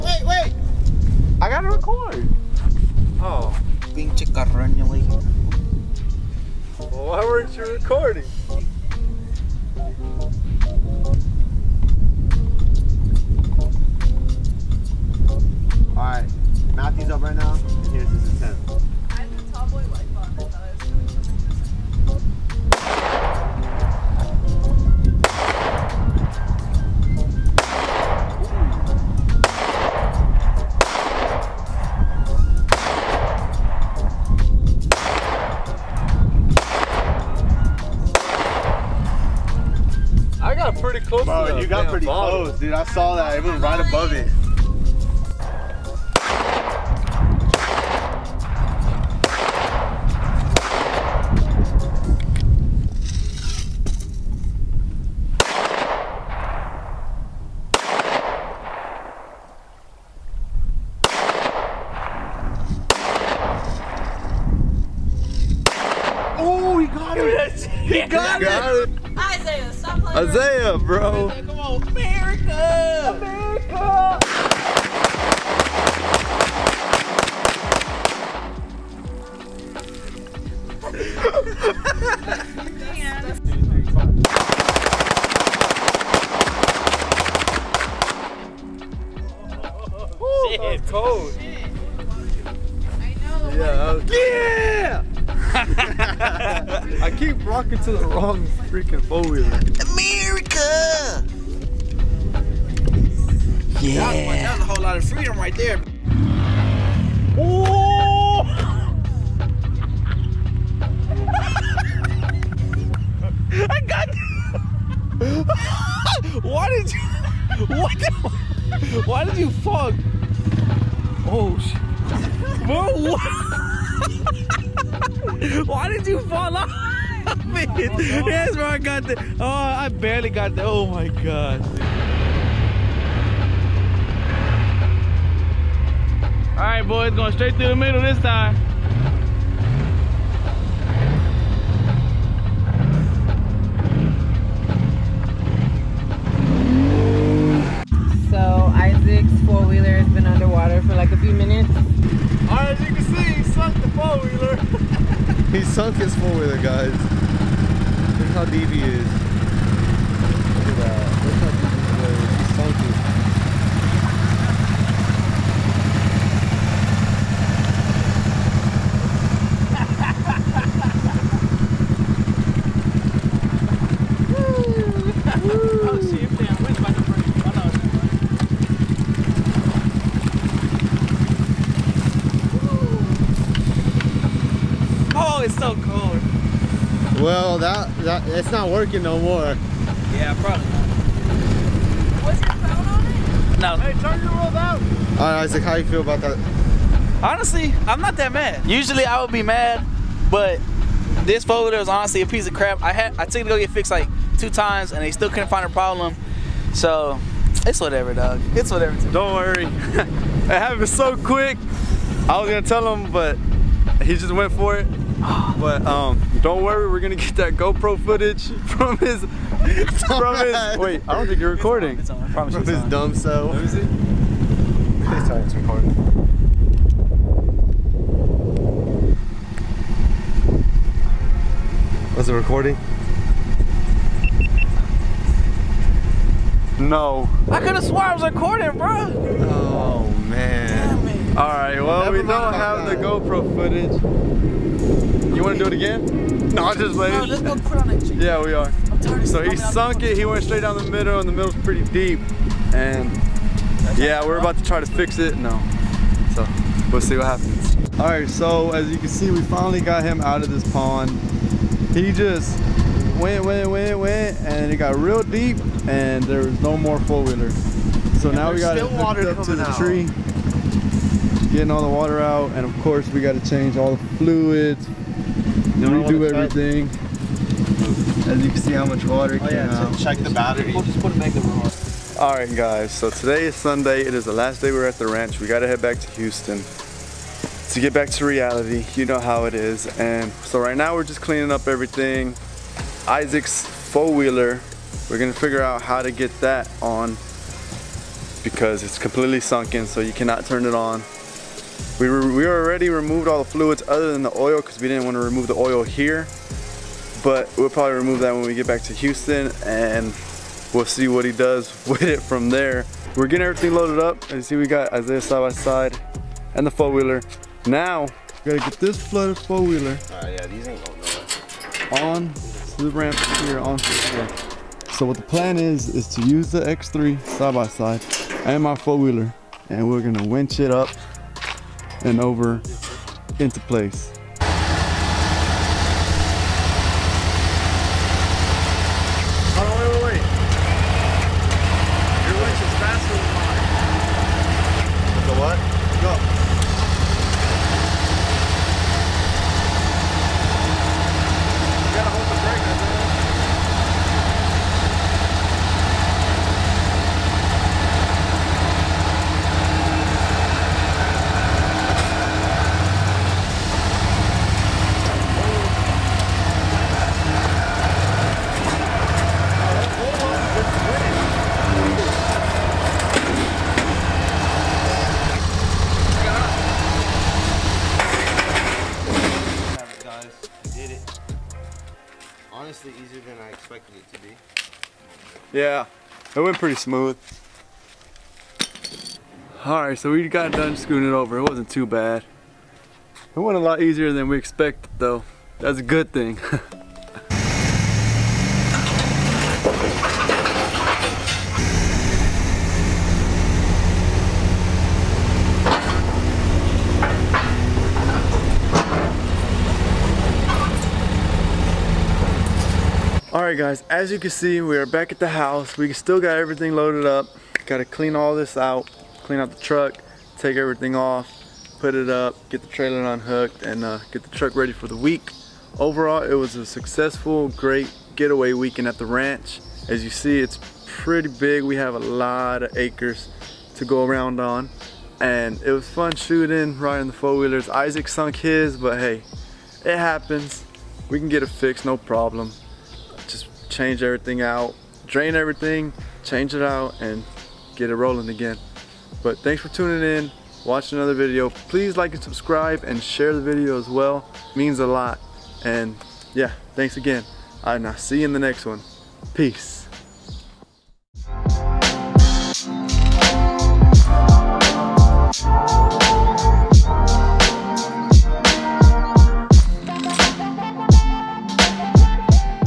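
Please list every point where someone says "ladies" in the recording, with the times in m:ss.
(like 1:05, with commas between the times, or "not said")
4:06.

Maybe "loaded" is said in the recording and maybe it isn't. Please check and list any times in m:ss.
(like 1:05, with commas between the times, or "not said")
5:13, 6:56.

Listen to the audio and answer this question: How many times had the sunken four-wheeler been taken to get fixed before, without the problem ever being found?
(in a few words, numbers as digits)
2.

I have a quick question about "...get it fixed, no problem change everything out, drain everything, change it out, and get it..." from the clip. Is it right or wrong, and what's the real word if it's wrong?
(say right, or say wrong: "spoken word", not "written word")
right.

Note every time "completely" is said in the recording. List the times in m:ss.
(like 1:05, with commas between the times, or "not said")
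4:58.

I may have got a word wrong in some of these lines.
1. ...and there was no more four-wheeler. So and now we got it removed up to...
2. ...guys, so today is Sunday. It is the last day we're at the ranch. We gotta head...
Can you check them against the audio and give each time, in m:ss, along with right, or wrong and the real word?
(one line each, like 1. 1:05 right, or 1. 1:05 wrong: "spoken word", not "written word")
1. 4:25 wrong: "hooked", not "removed"
2. 4:42 right.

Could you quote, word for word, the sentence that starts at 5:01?
We, we already removed all the fluids other than the oil because we didn't want to remove the oil here.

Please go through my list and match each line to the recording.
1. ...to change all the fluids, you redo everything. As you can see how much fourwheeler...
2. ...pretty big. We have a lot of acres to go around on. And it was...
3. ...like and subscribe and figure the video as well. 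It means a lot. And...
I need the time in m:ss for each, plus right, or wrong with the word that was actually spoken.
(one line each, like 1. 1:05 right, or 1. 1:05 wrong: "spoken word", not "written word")
1. 4:33 wrong: "water", not "fourwheeler"
2. 7:10 right
3. 7:31 wrong: "share", not "figure".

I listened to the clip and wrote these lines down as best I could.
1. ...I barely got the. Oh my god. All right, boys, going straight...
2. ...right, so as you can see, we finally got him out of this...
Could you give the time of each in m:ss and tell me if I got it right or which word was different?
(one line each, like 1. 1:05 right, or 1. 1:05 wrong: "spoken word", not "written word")
1. 2:09 right
2. 4:18 right.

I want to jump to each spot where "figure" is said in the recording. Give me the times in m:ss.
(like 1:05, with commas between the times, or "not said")
4:55.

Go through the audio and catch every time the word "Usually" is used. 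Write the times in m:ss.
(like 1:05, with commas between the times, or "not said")
3:18.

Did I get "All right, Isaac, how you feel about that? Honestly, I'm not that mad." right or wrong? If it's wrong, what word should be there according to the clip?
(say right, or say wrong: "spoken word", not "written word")
right.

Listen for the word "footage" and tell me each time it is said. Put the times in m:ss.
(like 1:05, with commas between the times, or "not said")
3:38, 4:03.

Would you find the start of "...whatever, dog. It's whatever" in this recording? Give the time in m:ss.
3:27.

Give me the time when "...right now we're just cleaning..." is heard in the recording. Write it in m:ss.
4:50.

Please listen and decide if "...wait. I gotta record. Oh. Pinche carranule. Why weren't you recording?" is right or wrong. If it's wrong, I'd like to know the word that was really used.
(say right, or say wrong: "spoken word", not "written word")
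right.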